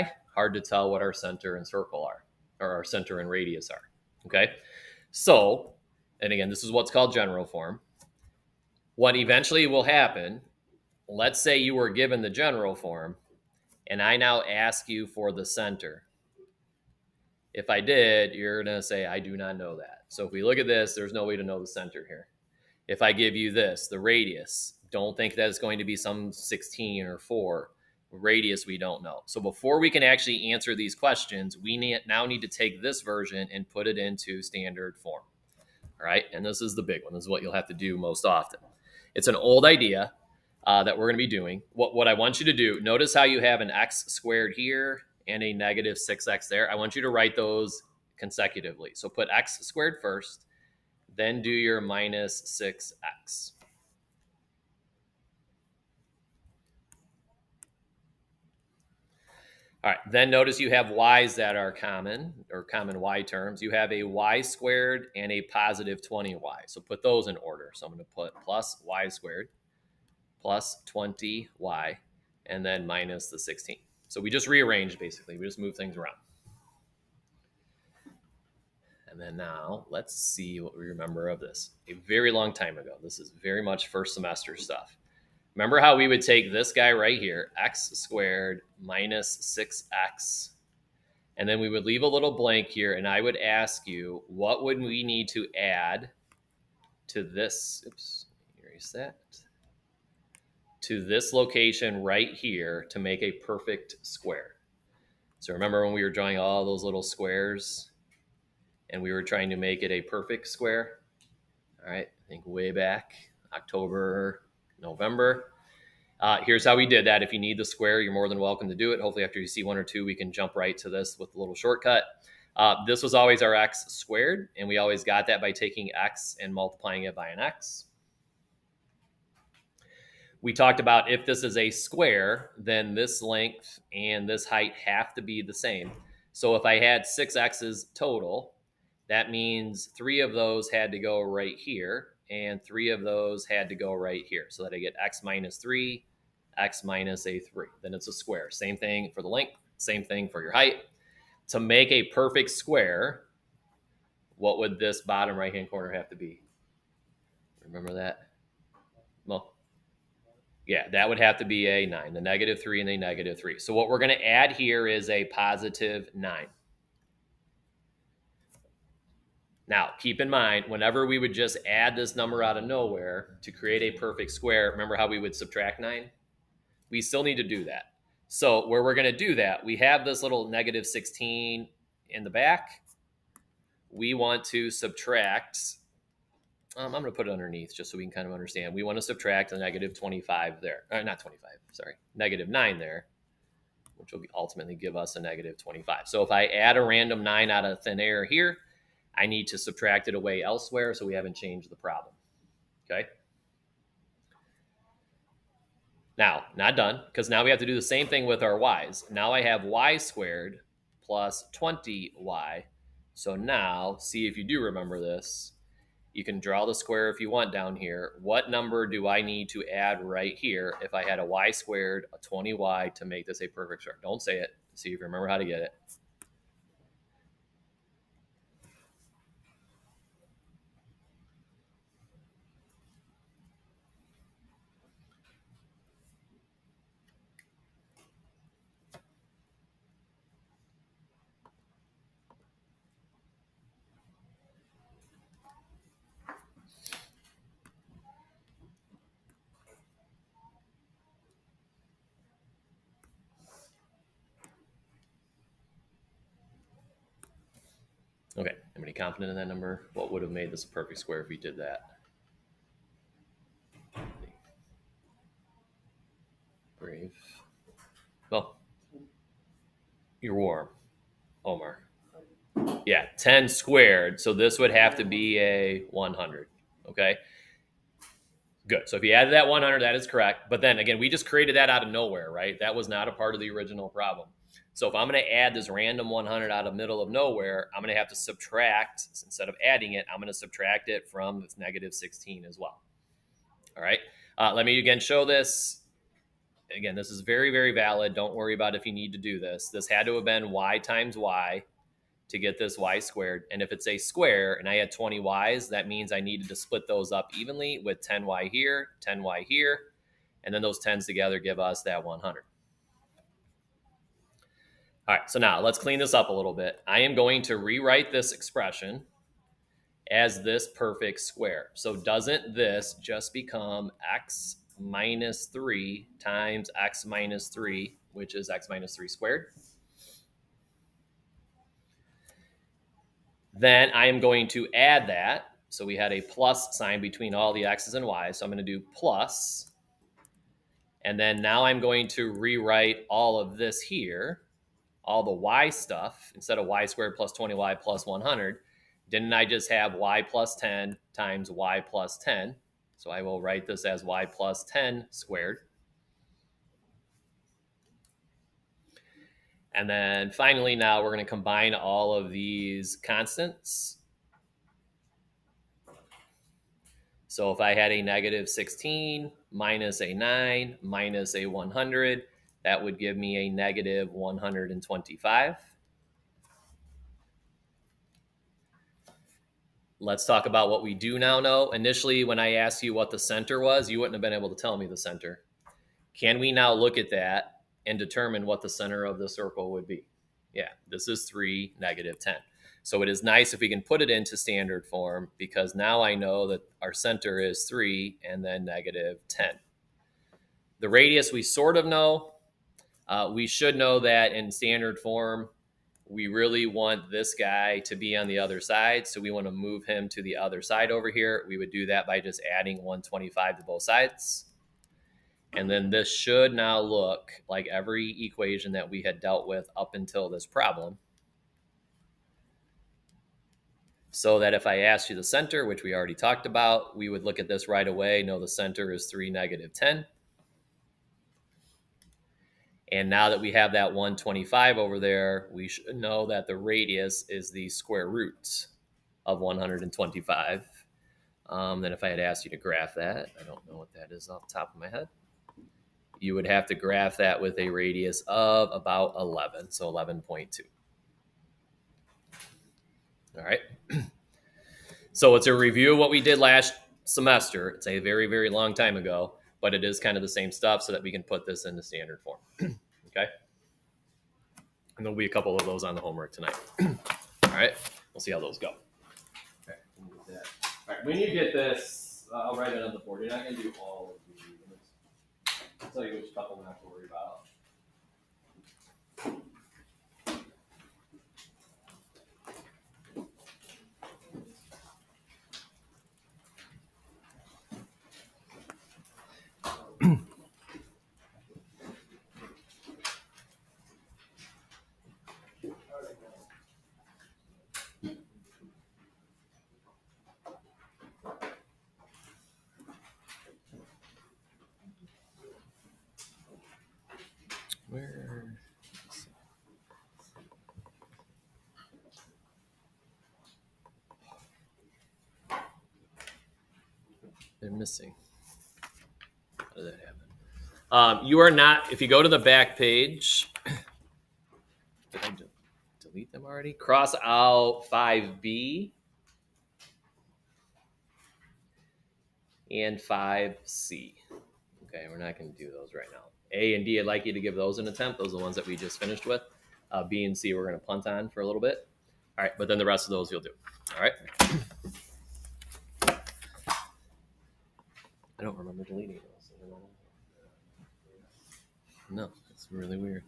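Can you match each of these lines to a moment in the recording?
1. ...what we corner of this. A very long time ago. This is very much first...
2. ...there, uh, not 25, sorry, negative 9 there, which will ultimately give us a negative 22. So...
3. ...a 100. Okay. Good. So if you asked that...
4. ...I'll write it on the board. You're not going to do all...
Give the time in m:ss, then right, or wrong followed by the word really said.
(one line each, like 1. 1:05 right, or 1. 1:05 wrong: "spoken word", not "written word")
1. 1:20 wrong: "remember", not "corner"
2. 3:10 wrong: "25", not "22"
3. 4:35 wrong: "added", not "asked"
4. 7:52 right.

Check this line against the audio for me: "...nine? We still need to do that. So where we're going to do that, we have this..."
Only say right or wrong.
right.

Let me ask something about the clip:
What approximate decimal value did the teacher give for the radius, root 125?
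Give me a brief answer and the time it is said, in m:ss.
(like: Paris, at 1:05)
11.2, at 7:29.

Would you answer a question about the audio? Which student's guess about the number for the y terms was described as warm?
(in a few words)
Omar.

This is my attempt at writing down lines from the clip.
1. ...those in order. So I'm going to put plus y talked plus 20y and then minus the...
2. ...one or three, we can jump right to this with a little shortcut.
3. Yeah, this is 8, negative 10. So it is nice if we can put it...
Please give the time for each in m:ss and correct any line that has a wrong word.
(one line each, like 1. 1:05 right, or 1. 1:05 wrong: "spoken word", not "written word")
1. 1:07 wrong: "squared", not "talked"
2. 1:59 wrong: "two", not "three"
3. 6:30 wrong: "3", not "8".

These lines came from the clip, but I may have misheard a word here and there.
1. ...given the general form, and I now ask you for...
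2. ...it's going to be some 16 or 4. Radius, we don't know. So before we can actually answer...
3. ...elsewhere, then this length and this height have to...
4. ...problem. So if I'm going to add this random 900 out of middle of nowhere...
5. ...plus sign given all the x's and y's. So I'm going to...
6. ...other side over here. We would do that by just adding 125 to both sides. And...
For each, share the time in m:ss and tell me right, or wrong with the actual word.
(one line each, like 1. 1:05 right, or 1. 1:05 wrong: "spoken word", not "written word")
1. 0:11 right
2. 0:25 right
3. 2:11 wrong: "square", not "elsewhere"
4. 4:43 wrong: "100", not "900"
5. 5:36 wrong: "between", not "given"
6. 6:50 right.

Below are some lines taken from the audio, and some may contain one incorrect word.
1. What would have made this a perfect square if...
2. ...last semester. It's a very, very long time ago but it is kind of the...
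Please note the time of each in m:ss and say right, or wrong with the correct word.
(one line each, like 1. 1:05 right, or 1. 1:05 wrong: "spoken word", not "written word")
1. 4:19 right
2. 7:36 right.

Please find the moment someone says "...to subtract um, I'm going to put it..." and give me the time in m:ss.
3:04.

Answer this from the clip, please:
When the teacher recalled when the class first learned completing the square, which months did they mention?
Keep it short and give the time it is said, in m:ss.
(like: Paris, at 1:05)
October, November, at 1:53.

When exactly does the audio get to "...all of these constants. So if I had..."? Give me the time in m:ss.
6:01.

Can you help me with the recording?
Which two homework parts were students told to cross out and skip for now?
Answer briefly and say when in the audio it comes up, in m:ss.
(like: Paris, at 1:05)
5B and 5C, at 8:47.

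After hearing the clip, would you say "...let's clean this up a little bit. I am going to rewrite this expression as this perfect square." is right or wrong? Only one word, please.
right.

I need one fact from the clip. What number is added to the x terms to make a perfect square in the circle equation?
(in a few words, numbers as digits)
9.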